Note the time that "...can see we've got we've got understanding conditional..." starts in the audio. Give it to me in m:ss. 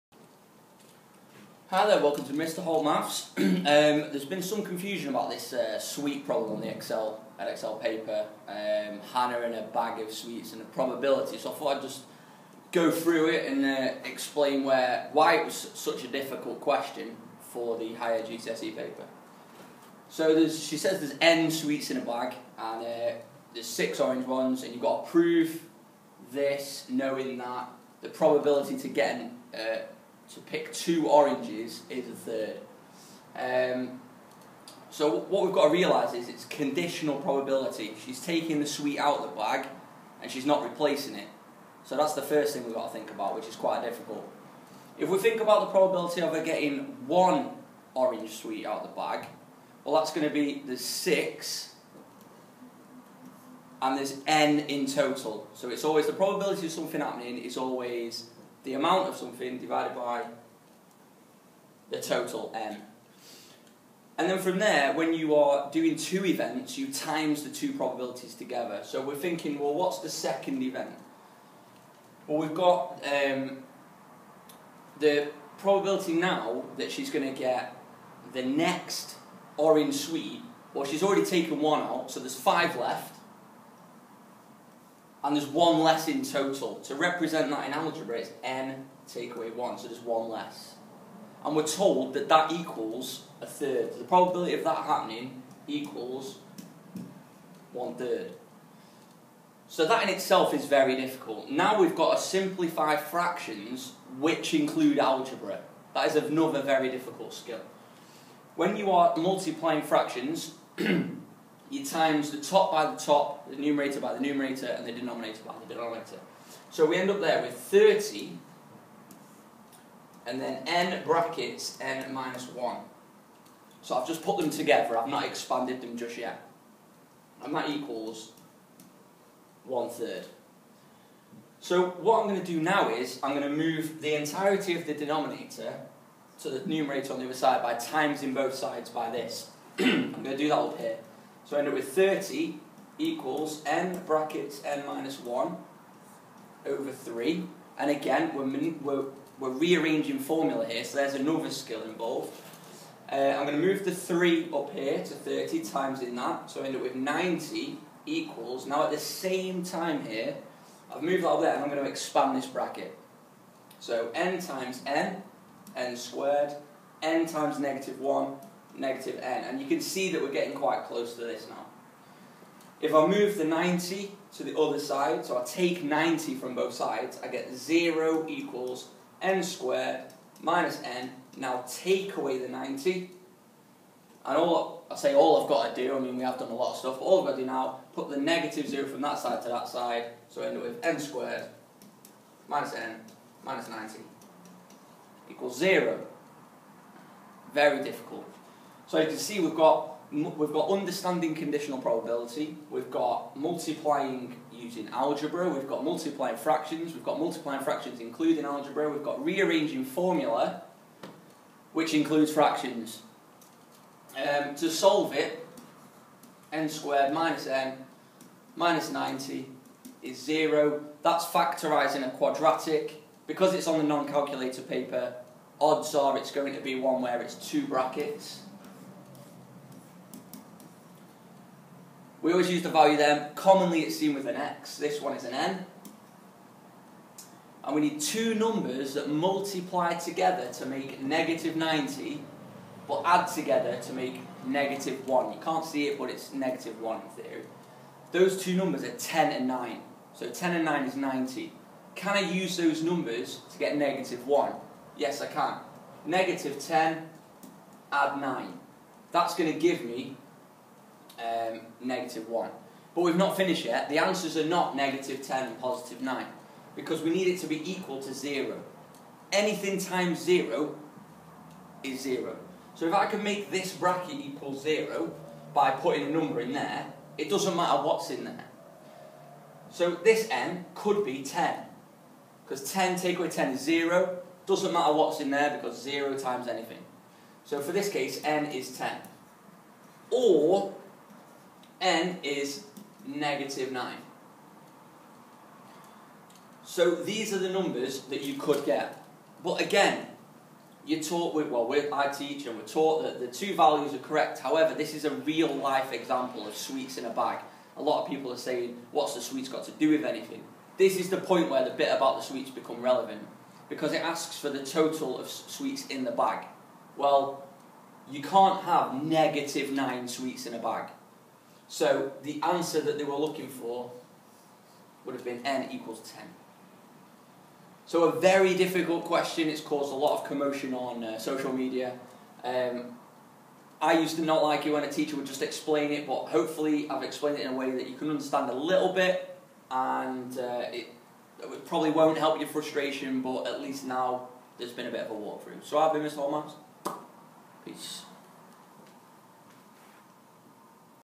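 3:19.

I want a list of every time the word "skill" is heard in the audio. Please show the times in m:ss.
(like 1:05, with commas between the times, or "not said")
1:47, 2:31.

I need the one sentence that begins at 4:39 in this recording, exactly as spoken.
So this n could be 10 because 10 take away 10 is 0.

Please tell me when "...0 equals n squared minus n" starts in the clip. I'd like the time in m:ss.
2:57.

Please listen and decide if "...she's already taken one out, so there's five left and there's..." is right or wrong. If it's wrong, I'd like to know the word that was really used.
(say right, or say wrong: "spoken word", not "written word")
right.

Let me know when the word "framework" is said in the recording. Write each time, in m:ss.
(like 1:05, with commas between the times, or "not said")
not said.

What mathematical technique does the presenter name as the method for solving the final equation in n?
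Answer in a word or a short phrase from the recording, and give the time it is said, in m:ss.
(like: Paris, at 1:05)
Factorising a quadratic, at 3:41.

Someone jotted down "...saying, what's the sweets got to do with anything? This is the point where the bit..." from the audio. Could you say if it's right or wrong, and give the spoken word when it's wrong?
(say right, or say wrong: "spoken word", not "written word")
right.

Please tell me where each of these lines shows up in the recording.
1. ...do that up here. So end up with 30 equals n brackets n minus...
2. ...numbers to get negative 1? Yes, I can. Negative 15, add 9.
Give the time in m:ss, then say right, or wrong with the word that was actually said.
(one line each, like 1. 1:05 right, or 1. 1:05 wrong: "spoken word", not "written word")
1. 2:20 right
2. 4:12 wrong: "10", not "15".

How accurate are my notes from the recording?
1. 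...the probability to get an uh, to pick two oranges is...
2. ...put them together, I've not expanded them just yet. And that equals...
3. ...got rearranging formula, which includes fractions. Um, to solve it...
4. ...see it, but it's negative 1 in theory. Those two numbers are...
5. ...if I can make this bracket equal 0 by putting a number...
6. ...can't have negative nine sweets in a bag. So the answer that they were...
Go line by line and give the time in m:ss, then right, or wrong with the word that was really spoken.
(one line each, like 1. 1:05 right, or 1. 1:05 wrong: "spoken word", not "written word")
1. 0:28 right
2. 2:04 right
3. 3:29 right
4. 4:05 right
5. 4:32 right
6. 5:18 right.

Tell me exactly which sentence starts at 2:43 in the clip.
So n times n, n squared, n times negative 1, negative n.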